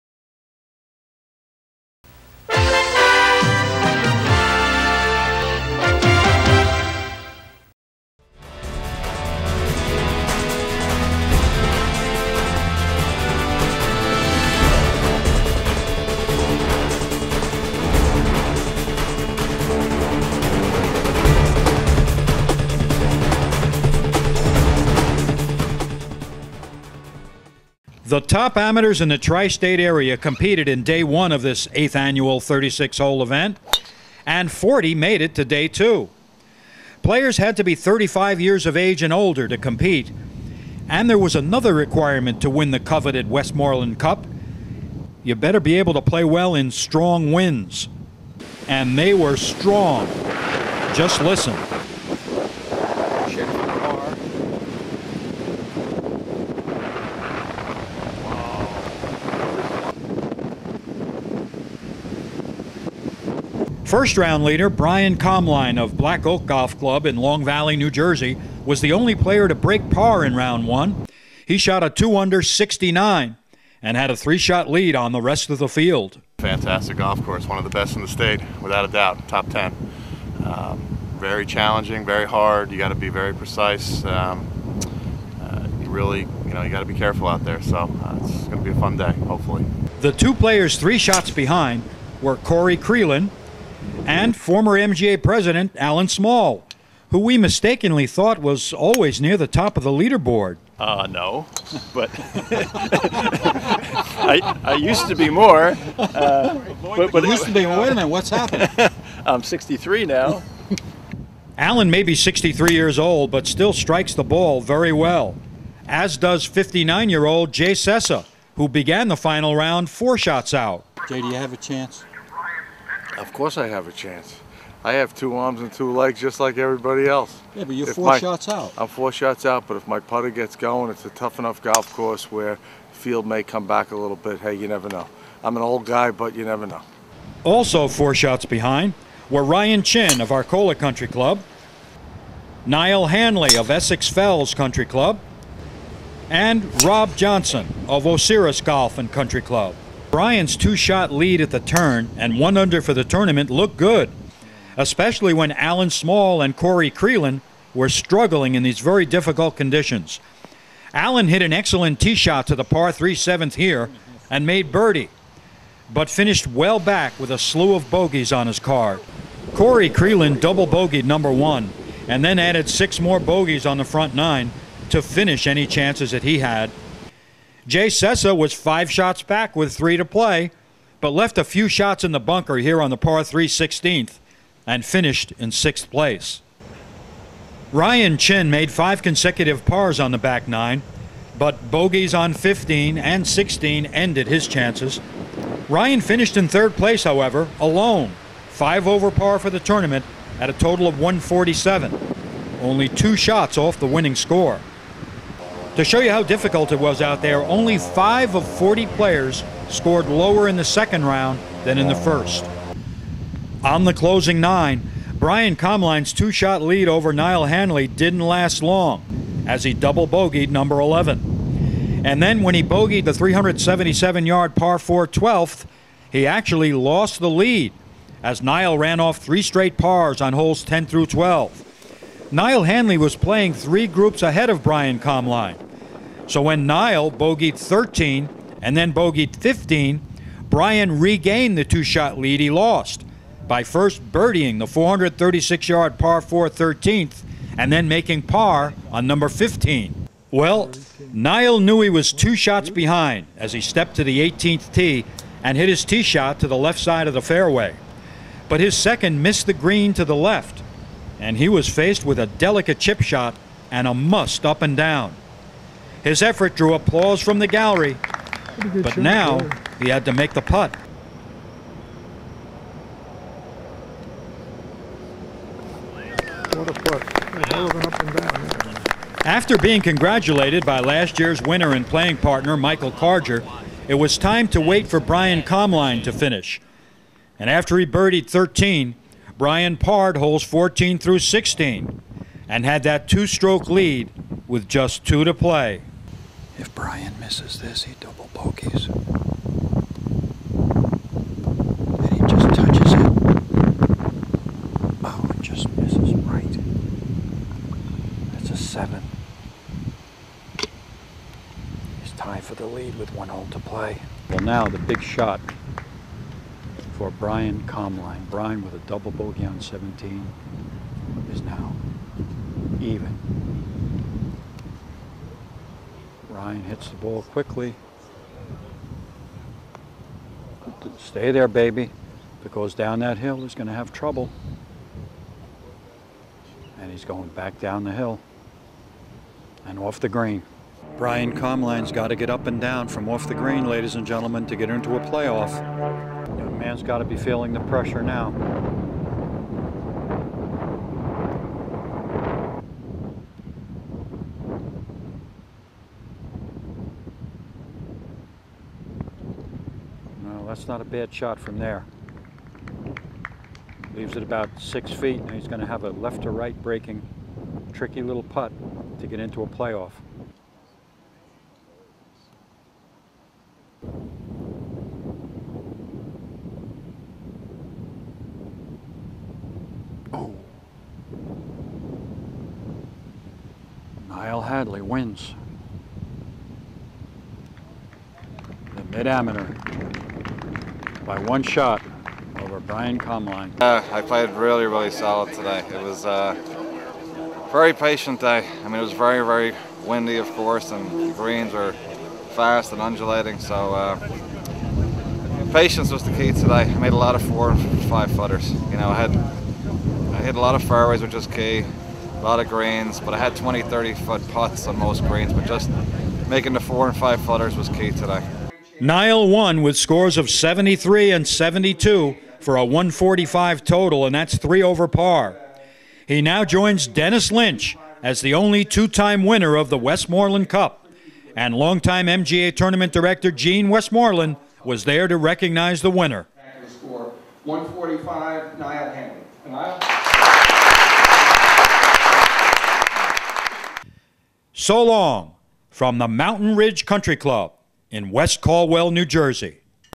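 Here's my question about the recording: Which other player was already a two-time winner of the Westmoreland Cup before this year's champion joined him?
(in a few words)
Dennis Lynch.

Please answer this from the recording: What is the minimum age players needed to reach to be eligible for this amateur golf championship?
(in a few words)
35.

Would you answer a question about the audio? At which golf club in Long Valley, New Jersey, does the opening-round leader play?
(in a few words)
Black Oak Golf Club.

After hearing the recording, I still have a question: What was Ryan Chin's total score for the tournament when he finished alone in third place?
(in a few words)
147.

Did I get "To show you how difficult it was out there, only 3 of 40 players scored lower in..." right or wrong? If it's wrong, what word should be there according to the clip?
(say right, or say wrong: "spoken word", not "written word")
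wrong: "5", not "3".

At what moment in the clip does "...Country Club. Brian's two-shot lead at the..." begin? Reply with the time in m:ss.
2:29.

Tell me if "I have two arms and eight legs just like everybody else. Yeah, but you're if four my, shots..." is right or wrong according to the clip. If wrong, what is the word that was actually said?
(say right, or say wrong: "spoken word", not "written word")
wrong: "two", not "eight".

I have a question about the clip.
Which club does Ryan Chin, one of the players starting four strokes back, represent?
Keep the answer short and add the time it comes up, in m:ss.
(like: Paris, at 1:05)
Arcola Country Club, at 2:20.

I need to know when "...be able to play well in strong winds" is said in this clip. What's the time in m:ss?
0:45.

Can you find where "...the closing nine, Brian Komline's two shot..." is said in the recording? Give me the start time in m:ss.
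3:33.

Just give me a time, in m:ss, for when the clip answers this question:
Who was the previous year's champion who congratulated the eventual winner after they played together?
4:42.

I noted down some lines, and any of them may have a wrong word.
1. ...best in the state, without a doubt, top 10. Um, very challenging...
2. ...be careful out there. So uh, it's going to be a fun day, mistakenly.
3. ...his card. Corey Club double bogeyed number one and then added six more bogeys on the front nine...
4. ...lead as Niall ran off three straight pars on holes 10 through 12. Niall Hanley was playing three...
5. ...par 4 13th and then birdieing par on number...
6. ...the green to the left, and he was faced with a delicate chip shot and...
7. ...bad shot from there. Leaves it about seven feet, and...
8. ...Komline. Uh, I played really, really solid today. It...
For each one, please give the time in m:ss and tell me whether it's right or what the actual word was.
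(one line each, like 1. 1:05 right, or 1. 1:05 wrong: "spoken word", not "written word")
1. 1:17 right
2. 1:26 wrong: "hopefully", not "mistakenly"
3. 2:48 wrong: "Creelan", not "Club"
4. 3:47 right
5. 4:05 wrong: "making", not "birdieing"
6. 4:19 right
7. 6:00 wrong: "six", not "seven"
8. 6:32 right.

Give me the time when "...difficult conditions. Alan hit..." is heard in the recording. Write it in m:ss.
2:39.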